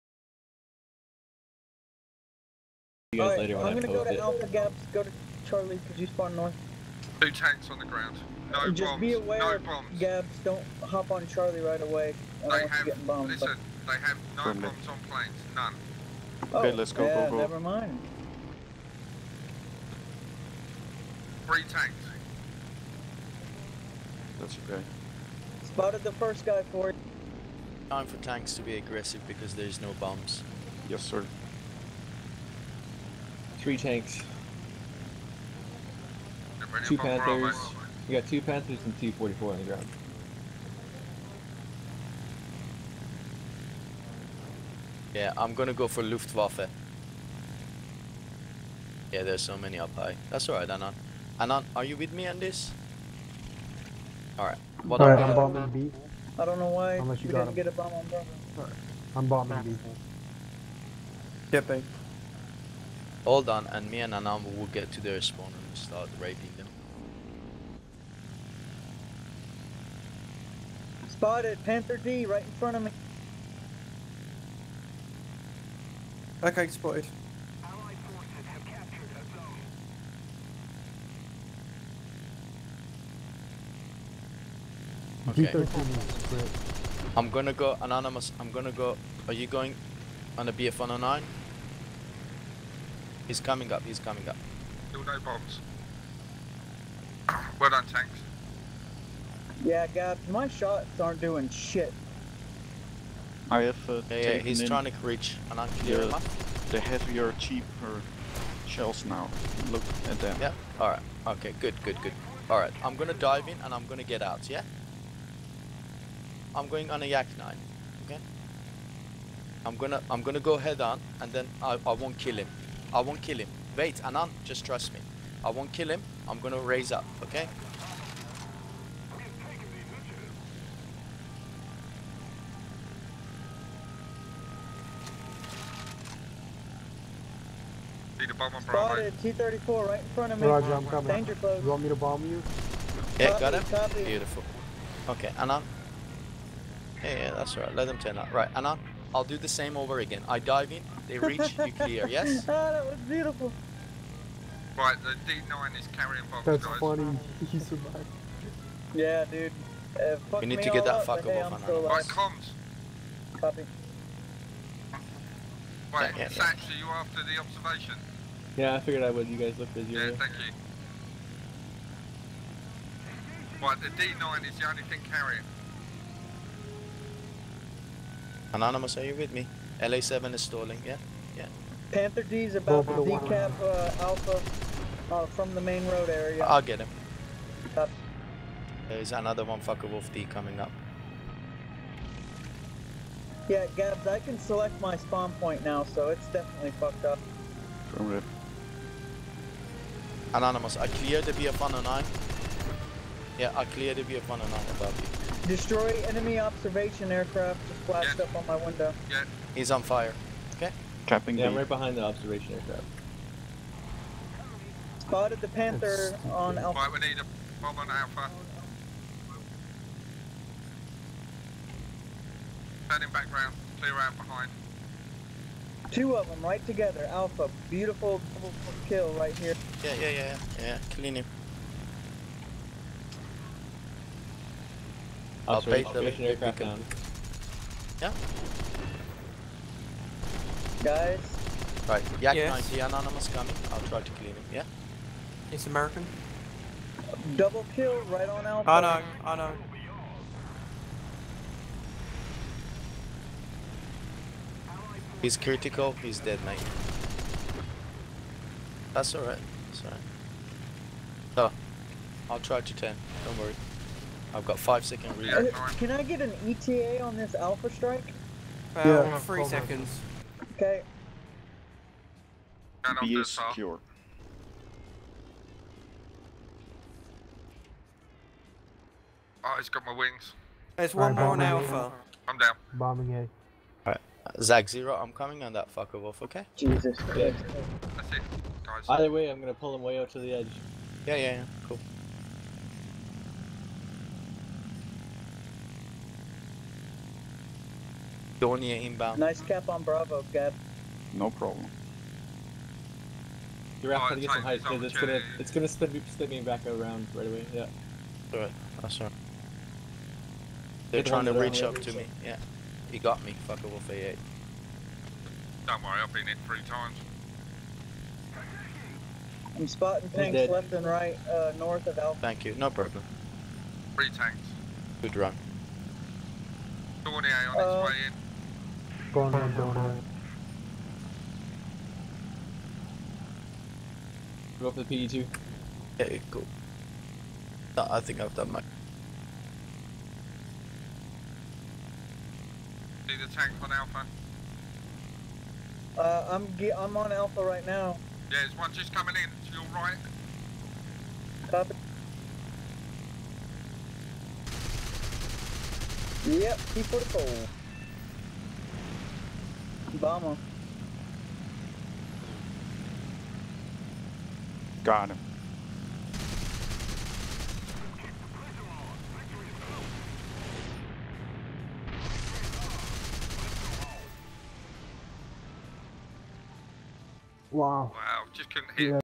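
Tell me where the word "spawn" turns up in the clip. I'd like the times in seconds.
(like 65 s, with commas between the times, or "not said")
6 s, 65 s, 194 s.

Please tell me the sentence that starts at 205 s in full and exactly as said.
Destroy enemy observation aircraft just flashed yeah.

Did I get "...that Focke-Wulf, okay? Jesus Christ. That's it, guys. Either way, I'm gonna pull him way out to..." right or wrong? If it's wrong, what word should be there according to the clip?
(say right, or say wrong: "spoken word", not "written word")
right.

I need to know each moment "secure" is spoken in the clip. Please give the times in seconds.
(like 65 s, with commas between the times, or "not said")
273 s.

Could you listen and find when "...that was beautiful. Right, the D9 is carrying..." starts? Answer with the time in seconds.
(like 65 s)
152 s.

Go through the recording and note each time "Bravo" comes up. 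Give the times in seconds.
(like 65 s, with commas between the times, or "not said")
58 s, 299 s.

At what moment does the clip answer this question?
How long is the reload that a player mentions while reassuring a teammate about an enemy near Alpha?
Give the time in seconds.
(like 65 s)
264 s.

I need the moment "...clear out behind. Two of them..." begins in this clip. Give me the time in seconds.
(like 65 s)
223 s.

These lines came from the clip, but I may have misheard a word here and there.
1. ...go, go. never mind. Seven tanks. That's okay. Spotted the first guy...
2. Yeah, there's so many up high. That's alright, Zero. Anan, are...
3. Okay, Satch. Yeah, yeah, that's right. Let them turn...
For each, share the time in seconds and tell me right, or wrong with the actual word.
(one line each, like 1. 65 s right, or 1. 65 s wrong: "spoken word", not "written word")
1. 17 s wrong: "Three", not "Seven"
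2. 49 s wrong: "Anan", not "Zero"
3. 145 s wrong: "Anand", not "Satch".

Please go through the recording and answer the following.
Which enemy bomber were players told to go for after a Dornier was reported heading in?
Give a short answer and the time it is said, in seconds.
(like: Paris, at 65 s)
PE2, at 335 s.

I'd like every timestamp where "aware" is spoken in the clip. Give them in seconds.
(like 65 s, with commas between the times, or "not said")
9 s.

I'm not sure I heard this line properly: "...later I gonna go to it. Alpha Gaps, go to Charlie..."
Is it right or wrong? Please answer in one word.
right.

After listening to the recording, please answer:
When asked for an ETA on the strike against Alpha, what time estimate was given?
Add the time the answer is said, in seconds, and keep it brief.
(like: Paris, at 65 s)
3 seconds, at 269 s.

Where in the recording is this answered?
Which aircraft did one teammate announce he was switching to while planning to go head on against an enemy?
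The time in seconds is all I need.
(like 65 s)
117 s.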